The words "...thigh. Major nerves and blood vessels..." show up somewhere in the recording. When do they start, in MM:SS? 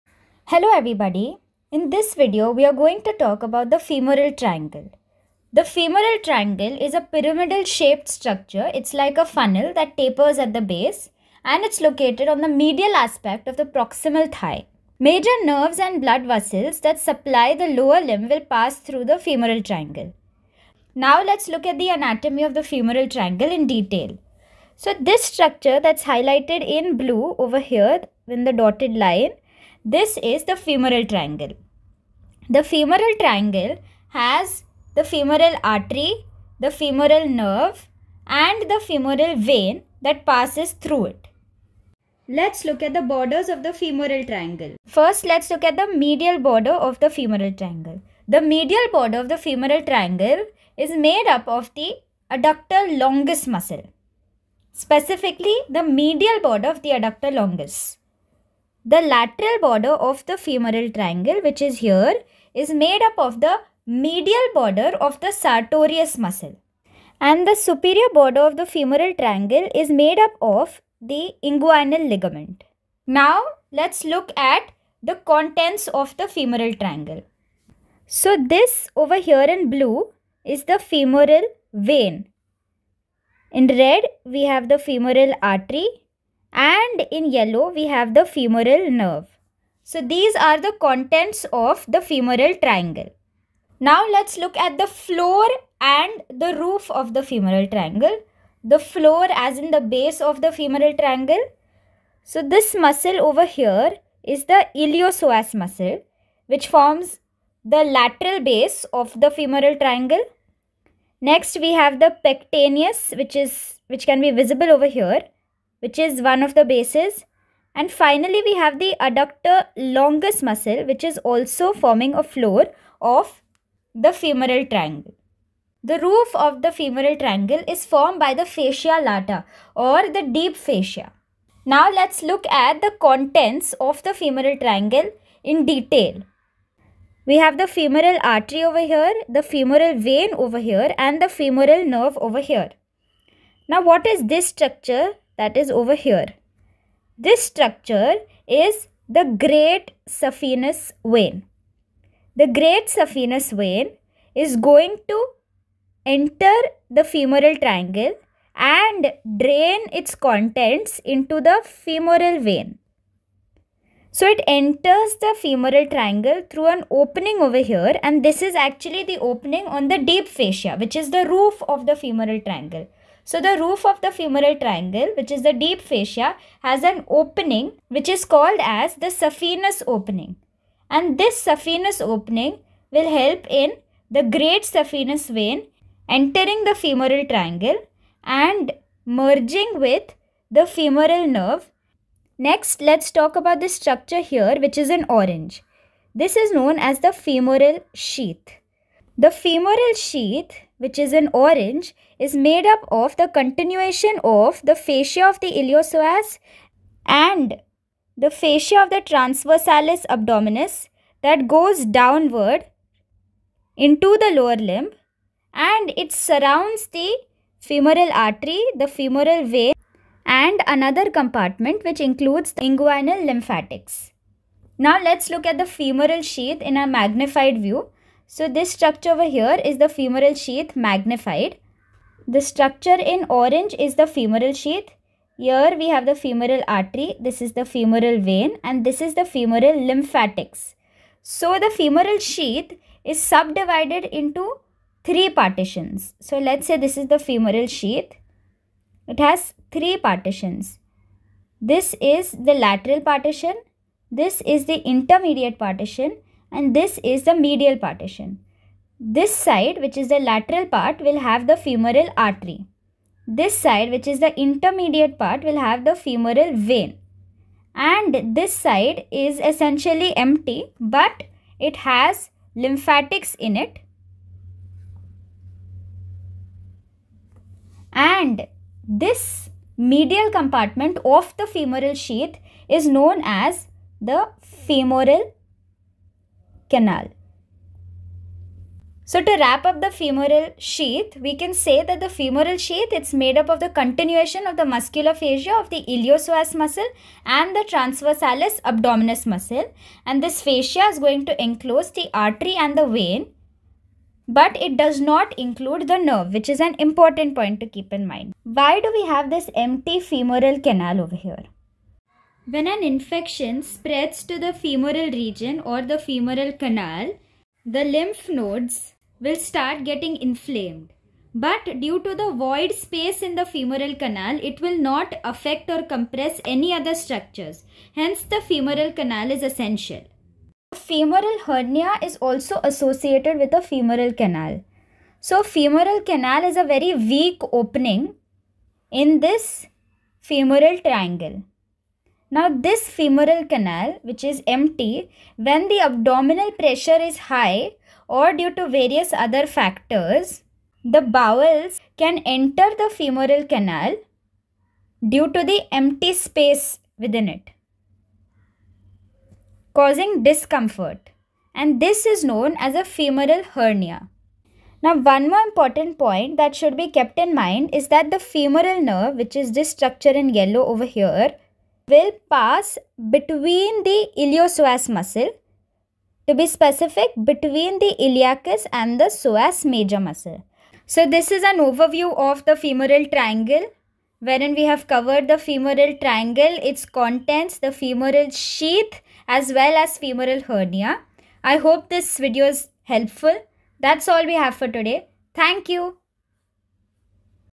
00:14.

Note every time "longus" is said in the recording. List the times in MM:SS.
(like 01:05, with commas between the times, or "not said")
00:52, 00:57, 01:59.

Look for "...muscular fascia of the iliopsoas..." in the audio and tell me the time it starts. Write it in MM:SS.
04:54.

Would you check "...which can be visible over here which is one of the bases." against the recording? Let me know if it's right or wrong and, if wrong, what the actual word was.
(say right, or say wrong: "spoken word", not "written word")
right.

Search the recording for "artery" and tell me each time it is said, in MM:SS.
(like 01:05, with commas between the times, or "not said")
00:35, 01:25, 02:18, 03:38, 03:56, 04:22, 05:02.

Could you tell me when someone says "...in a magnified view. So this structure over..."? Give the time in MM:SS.
03:46.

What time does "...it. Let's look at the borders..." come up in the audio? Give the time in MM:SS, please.
00:41.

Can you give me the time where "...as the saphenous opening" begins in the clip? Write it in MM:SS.
02:58.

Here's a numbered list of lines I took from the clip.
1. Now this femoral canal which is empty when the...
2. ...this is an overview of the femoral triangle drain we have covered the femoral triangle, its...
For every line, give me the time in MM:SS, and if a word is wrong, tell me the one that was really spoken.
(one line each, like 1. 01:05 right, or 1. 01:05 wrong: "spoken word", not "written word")
1. 05:42 right
2. 06:21 wrong: "wherein", not "drain".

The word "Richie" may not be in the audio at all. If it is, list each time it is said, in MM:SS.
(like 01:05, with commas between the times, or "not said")
not said.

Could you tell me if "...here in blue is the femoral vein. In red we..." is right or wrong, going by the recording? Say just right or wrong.
right.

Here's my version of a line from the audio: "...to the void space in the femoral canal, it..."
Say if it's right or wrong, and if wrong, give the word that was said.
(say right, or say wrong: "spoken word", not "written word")
right.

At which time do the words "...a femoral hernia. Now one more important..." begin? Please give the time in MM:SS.
06:02.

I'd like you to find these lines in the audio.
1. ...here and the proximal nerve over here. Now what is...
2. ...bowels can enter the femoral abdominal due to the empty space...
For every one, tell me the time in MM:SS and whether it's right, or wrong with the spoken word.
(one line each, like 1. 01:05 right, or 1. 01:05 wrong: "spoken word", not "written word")
1. 02:20 wrong: "femoral", not "proximal"
2. 05:51 wrong: "canal", not "abdominal".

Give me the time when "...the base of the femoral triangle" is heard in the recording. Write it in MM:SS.
01:39.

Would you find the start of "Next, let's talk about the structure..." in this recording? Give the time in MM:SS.
03:12.